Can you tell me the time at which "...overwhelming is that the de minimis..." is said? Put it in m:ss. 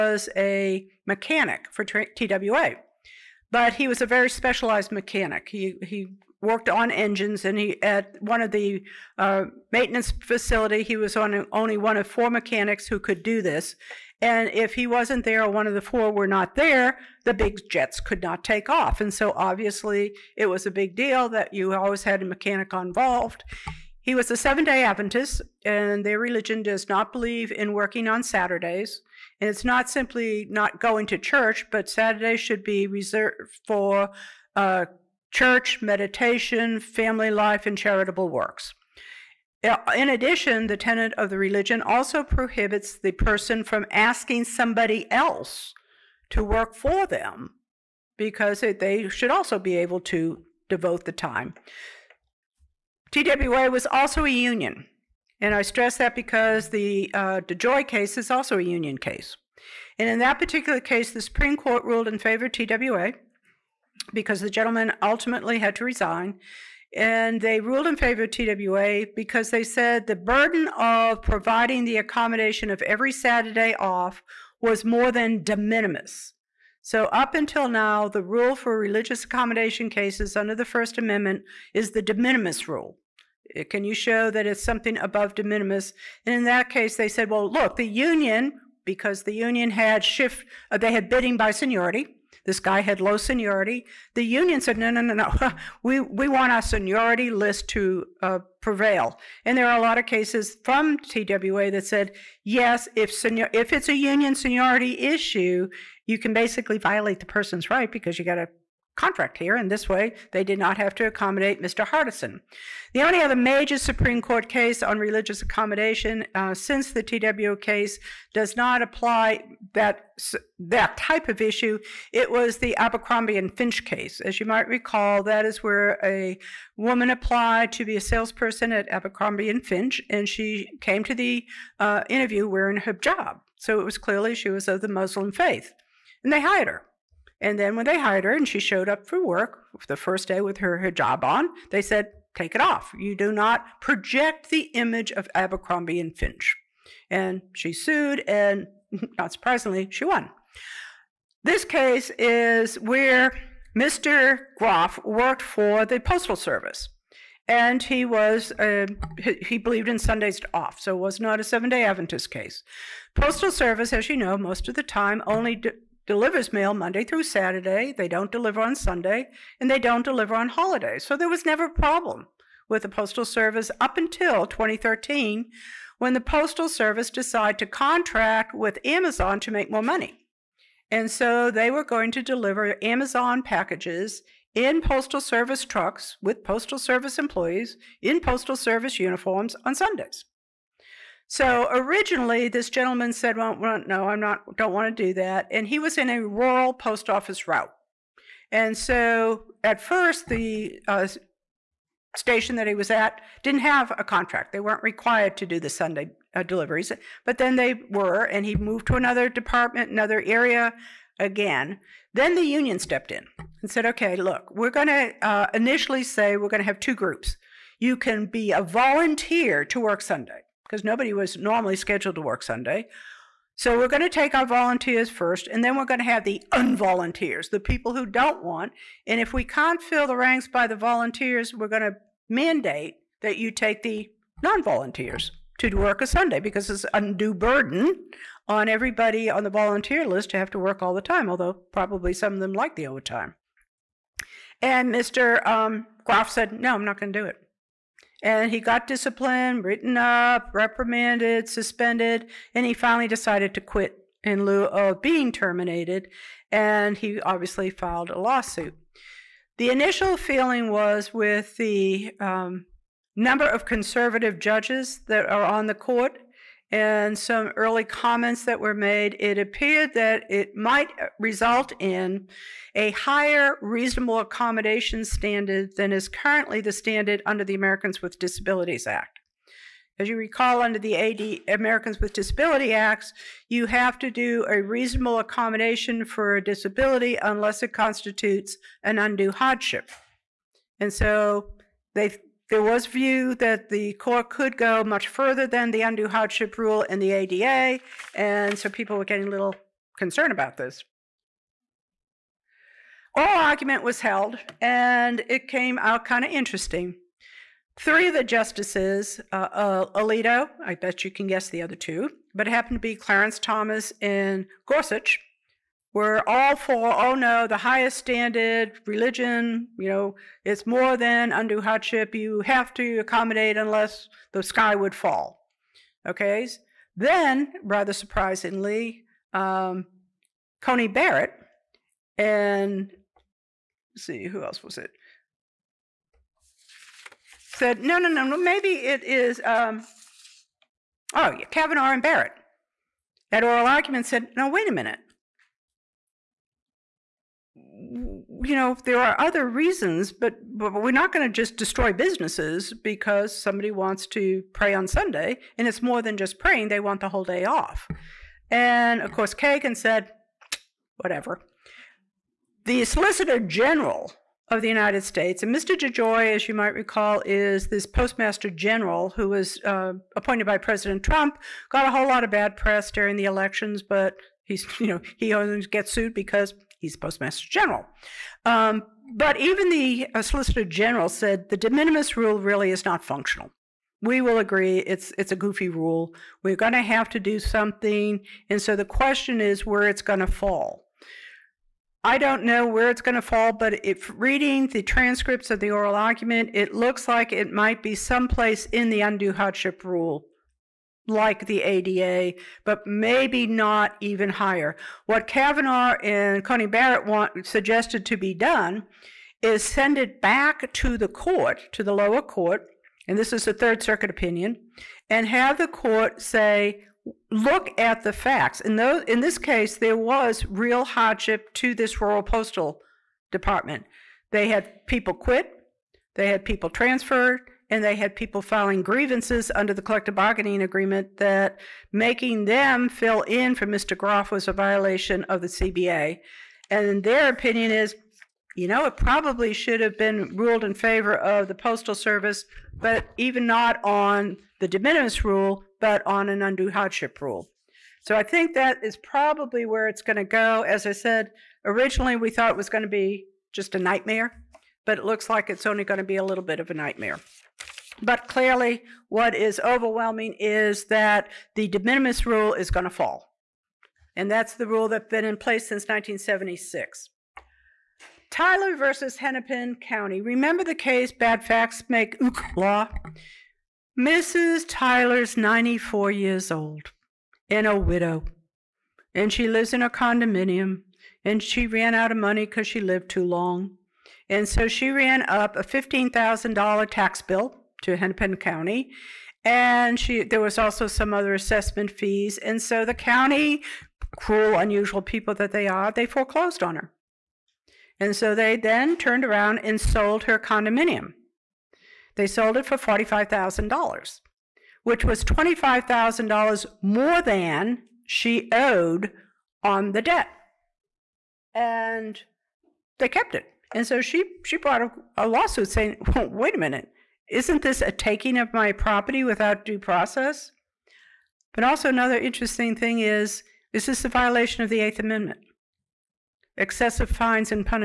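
7:39.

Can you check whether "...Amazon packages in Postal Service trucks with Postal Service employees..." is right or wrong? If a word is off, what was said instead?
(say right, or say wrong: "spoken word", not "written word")
right.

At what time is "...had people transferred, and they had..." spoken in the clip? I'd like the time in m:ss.
7:06.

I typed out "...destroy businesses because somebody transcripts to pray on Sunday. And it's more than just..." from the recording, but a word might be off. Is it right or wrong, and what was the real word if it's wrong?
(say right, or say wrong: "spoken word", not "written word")
wrong: "wants", not "transcripts".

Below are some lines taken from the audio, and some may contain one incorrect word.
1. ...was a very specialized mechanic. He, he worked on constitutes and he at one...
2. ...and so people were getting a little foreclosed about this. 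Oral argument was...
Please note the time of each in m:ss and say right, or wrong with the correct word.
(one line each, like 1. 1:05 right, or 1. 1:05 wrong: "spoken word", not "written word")
1. 0:03 wrong: "engines", not "constitutes"
2. 4:58 wrong: "concerned", not "foreclosed".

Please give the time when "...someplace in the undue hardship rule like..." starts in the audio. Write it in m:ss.
6:38.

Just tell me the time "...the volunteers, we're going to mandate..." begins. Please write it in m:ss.
3:50.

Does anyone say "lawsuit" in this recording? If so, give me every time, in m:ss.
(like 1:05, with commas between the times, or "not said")
4:18, 8:35.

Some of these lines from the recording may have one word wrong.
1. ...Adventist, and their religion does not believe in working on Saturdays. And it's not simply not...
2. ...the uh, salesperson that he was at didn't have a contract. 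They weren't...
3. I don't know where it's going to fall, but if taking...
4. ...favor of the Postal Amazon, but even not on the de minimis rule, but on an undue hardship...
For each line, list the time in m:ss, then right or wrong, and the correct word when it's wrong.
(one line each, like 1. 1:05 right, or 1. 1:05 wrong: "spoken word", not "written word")
1. 0:24 right
2. 3:20 wrong: "station", not "salesperson"
3. 6:32 wrong: "reading", not "taking"
4. 7:20 wrong: "Service", not "Amazon".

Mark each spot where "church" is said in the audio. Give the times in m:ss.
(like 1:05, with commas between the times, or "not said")
0:31, 0:35.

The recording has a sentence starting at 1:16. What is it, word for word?
So, up until now, the rule for religious accommodation cases under the First Amendment is the de minimis rule.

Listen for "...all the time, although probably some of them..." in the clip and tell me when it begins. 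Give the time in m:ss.
4:00.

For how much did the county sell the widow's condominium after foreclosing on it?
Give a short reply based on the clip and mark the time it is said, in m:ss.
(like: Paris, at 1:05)
$45,000, at 8:22.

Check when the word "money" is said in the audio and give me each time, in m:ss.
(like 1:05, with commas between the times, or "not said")
2:59, 8:02.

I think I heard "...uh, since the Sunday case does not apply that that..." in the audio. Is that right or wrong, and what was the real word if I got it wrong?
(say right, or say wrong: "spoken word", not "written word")
wrong: "TWA", not "Sunday".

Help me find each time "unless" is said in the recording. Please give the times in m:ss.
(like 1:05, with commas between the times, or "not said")
4:47, 5:23.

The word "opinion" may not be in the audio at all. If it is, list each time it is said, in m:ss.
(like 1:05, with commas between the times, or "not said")
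6:54, 7:17.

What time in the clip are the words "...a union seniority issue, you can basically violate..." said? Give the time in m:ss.
1:43.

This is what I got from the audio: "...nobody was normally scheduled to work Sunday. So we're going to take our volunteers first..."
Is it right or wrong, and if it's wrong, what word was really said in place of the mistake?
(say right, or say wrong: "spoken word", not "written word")
right.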